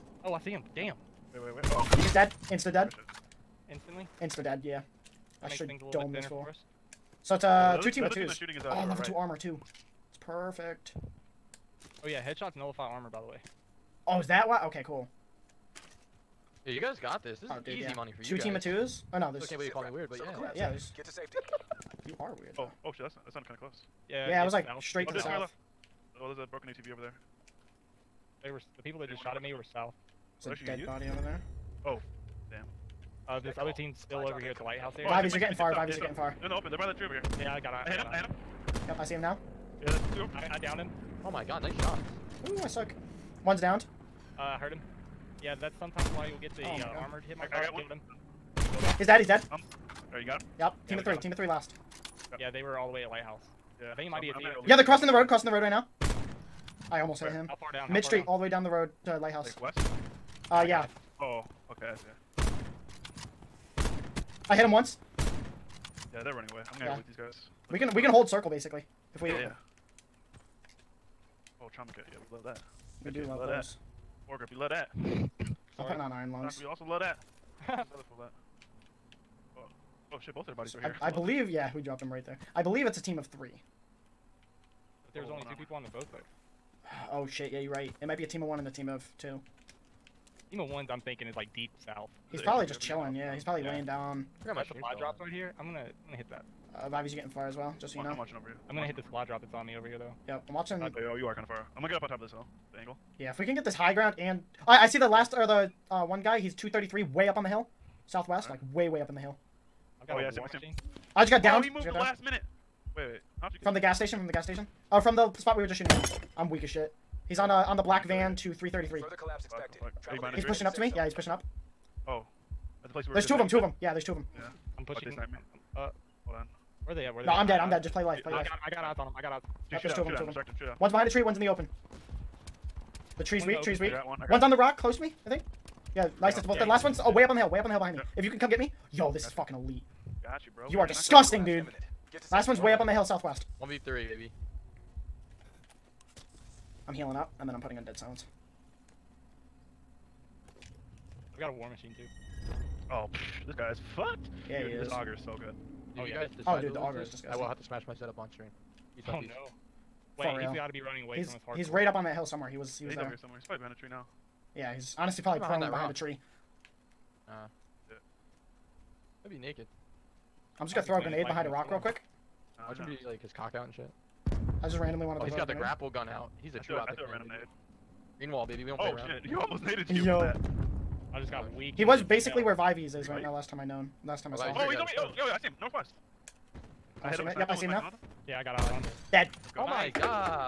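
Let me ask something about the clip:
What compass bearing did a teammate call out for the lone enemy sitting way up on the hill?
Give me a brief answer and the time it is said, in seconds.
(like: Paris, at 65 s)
233, at 106 s.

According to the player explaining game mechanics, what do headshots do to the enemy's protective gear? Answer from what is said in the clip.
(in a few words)
nullify armor.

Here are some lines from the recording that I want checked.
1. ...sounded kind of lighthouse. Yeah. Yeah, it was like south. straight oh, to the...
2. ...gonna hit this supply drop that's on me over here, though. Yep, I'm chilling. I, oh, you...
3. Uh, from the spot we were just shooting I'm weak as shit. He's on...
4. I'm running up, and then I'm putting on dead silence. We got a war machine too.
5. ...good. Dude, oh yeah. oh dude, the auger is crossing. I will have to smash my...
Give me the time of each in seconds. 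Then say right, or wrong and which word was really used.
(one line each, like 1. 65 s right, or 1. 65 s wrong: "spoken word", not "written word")
1. 23 s wrong: "close", not "lighthouse"
2. 98 s wrong: "watching", not "chilling"
3. 114 s right
4. 146 s wrong: "healing", not "running"
5. 155 s wrong: "disgusting", not "crossing".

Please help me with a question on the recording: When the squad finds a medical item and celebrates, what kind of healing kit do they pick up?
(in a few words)
trauma kit.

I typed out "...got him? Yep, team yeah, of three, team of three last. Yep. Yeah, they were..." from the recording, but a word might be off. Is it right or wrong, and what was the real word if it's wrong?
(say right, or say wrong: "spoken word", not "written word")
right.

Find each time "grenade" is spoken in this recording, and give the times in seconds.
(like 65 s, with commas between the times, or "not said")
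171 s, 175 s.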